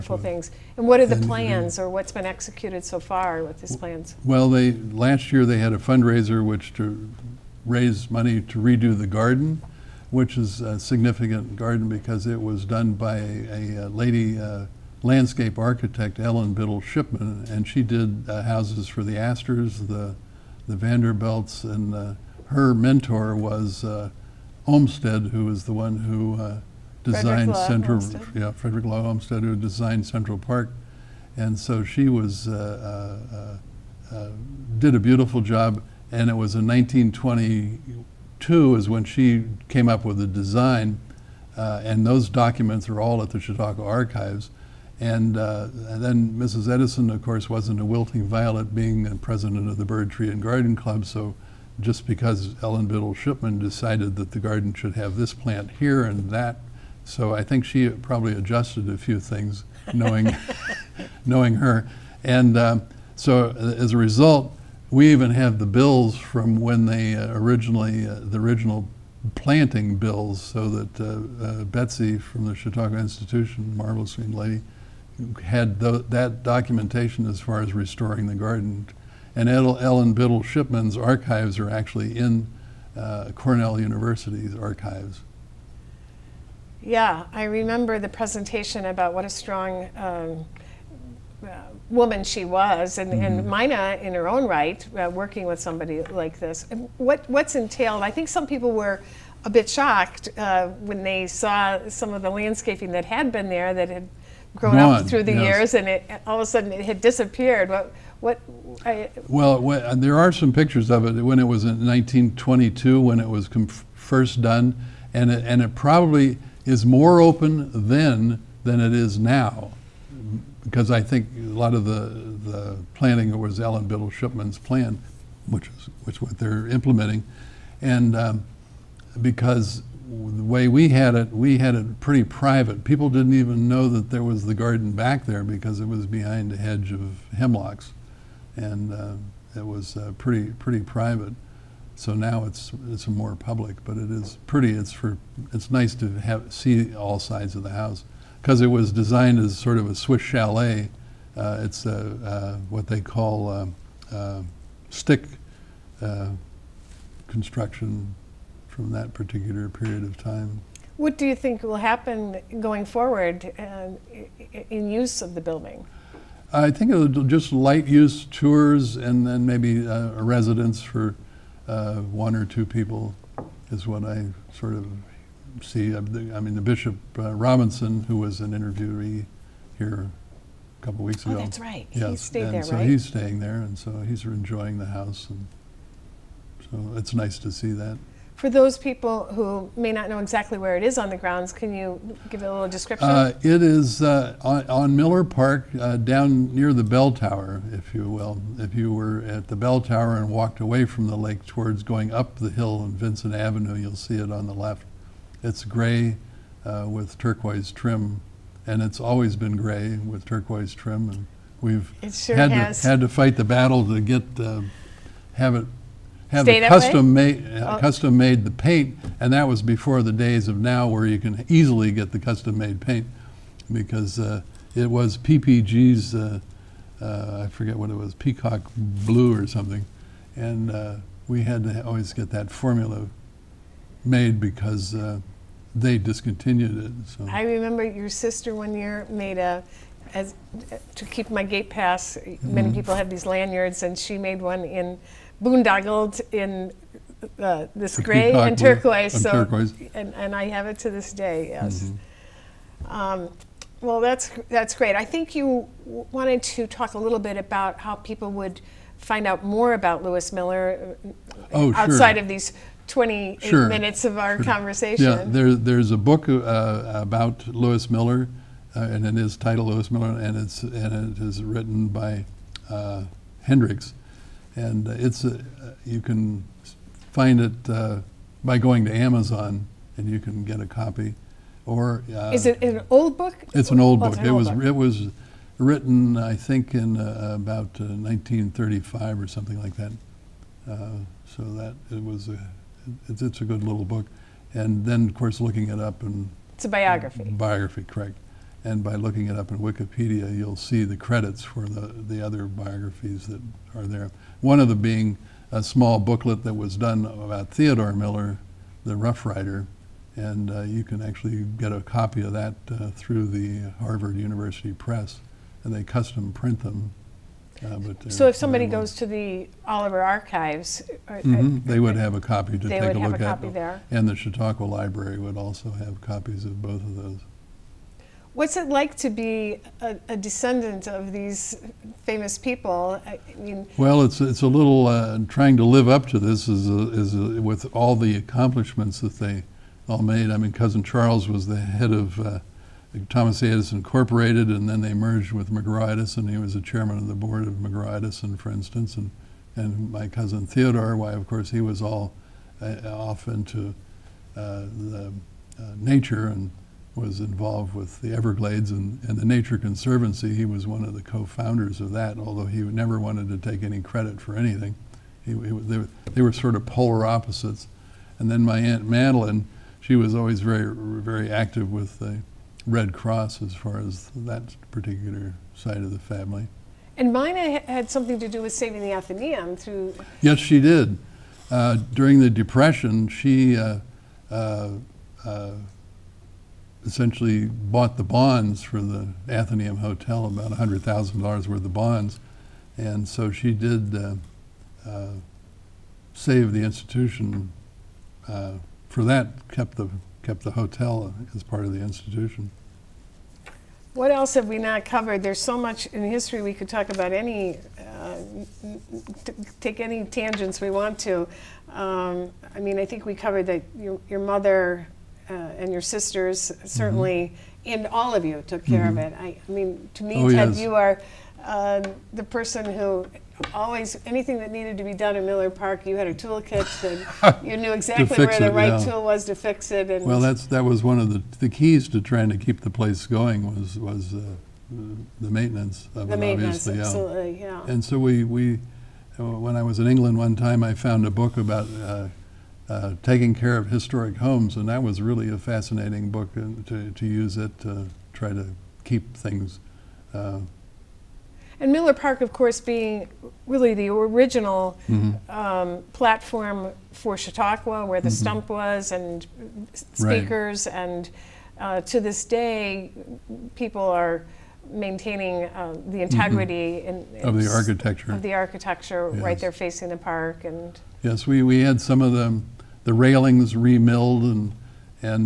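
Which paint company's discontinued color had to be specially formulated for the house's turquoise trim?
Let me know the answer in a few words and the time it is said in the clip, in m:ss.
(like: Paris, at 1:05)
PPG, at 3:45.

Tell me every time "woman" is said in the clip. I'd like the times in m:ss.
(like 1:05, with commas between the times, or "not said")
1:31.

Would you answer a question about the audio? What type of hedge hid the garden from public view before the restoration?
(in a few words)
Hemlocks.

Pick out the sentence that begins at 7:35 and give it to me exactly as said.
um, platform for Chautauqua, where the mm-hmm.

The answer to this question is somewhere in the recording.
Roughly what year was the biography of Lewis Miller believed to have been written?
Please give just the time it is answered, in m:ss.
4:47.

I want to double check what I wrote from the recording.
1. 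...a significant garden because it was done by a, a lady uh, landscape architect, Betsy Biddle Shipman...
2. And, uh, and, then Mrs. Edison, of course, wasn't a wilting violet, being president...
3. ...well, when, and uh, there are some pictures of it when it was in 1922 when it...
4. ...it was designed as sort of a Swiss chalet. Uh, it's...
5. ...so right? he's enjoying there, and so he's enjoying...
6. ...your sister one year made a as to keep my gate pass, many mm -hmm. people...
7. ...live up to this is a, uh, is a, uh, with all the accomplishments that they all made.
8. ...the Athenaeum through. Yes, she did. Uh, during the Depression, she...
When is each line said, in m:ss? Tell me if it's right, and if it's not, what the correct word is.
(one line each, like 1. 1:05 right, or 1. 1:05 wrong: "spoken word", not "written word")
1. 0:10 wrong: "Ellen", not "Betsy"
2. 0:45 right
3. 1:49 right
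4. 2:28 right
5. 3:02 wrong: "staying", not "enjoying"
6. 3:57 right
7. 5:35 right
8. 6:18 right.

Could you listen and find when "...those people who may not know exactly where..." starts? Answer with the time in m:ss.
3:08.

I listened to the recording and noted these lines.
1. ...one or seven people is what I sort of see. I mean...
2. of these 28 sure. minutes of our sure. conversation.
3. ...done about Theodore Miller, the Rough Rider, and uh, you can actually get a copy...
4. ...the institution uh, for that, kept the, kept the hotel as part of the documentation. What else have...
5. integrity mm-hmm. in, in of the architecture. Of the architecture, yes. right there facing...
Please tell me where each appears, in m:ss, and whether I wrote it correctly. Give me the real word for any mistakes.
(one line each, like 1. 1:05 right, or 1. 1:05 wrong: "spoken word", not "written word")
1. 2:51 wrong: "two", not "seven"
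2. 4:22 right
3. 5:06 right
4. 6:36 wrong: "institution", not "documentation"
5. 7:46 right.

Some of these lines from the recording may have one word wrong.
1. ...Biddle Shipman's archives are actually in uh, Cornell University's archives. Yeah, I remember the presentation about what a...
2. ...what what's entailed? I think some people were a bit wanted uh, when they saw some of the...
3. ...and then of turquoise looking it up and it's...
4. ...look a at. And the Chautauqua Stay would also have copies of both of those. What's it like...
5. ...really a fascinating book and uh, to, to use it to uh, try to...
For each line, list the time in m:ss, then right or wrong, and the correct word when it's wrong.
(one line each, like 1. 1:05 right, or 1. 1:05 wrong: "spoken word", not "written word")
1. 1:20 right
2. 1:36 wrong: "shocked", not "wanted"
3. 4:54 wrong: "course", not "turquoise"
4. 5:22 wrong: "Library", not "Stay"
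5. 7:25 right.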